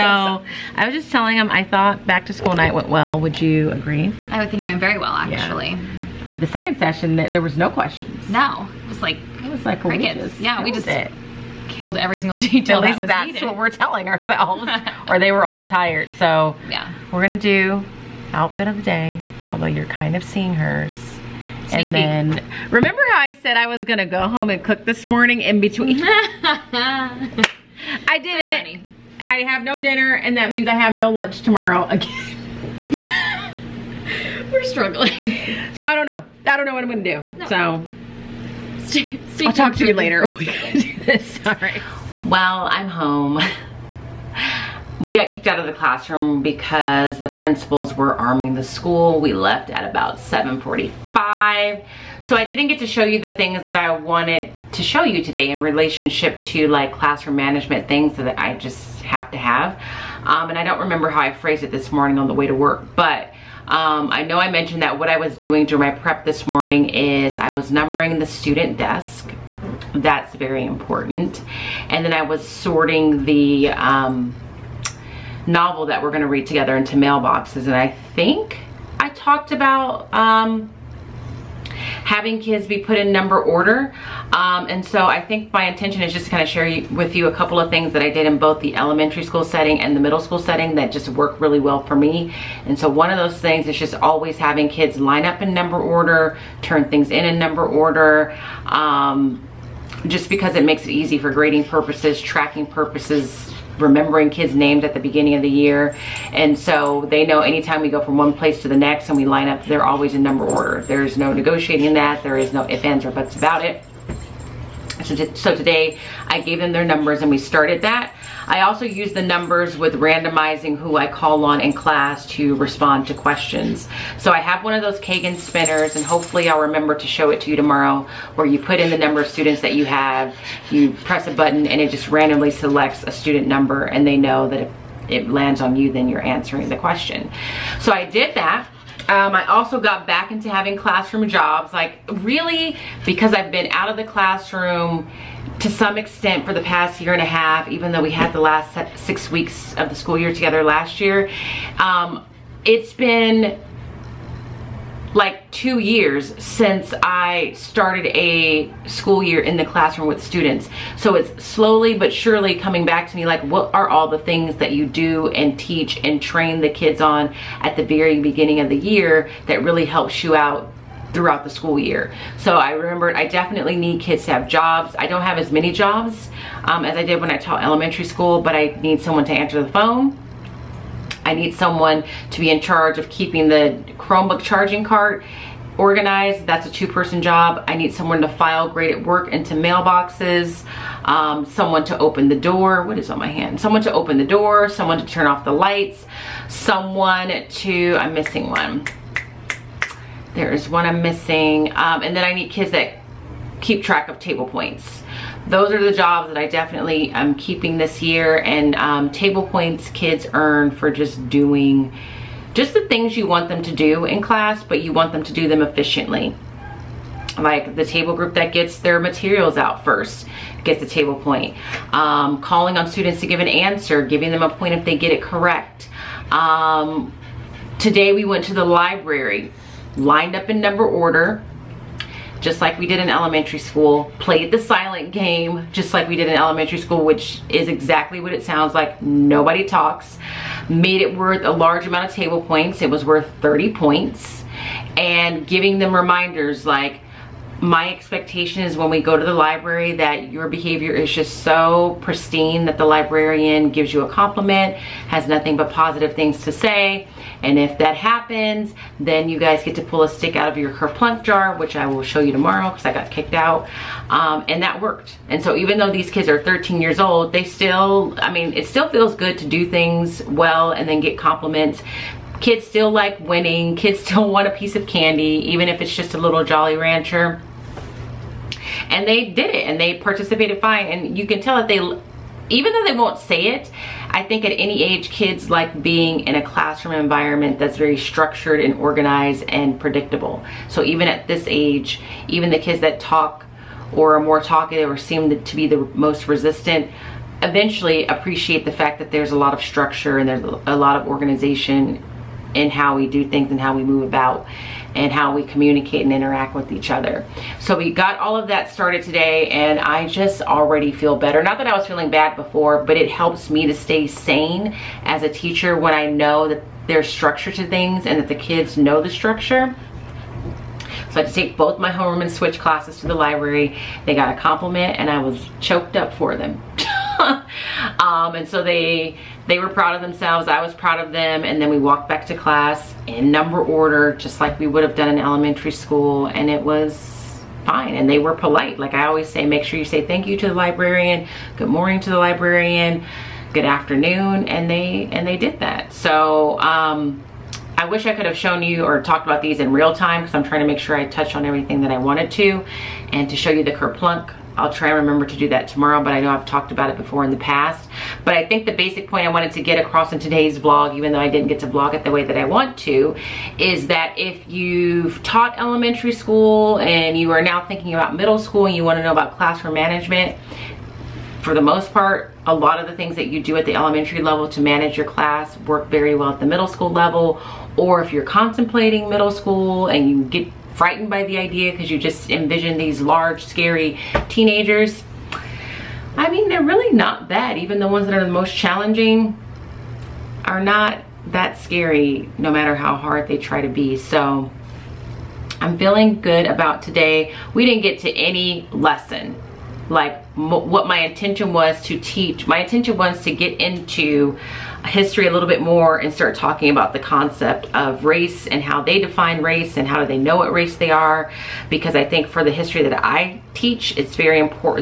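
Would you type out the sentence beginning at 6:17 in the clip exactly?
Or if you're contemplating middle school and you get frightened by the idea because you just envision these large, scary teenagers.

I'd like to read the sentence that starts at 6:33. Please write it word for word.
So I'm feeling good about today.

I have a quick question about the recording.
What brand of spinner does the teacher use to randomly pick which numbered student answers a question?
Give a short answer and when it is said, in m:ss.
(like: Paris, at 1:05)
Kagan, at 2:05.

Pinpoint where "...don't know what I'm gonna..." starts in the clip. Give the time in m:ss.
0:36.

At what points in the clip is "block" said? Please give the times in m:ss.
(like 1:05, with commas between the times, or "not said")
not said.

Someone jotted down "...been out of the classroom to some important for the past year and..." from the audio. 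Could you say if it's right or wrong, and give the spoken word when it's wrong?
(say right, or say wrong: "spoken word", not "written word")
wrong: "extent", not "important".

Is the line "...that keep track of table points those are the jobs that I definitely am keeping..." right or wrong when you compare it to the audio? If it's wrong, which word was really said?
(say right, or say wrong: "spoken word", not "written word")
right.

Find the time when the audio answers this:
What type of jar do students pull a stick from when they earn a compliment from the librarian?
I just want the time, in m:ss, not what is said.
4:20.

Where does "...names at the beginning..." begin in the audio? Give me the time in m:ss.
1:44.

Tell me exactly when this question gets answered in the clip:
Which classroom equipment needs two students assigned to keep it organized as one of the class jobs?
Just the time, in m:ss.
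3:03.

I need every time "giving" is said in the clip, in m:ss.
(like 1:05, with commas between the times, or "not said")
3:44, 4:05.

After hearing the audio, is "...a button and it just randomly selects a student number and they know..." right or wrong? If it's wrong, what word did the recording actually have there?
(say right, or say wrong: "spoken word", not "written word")
right.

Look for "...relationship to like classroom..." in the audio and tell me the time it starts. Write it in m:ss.
0:55.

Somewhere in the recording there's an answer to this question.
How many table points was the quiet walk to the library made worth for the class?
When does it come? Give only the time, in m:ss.
4:03.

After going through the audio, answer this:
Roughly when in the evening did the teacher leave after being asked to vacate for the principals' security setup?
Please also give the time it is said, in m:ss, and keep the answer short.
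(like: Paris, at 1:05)
7:45, at 0:50.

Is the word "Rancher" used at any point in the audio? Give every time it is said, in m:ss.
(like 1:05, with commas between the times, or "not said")
4:36.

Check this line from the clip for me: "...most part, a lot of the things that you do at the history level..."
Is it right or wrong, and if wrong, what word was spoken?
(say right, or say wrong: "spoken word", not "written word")
wrong: "elementary", not "history".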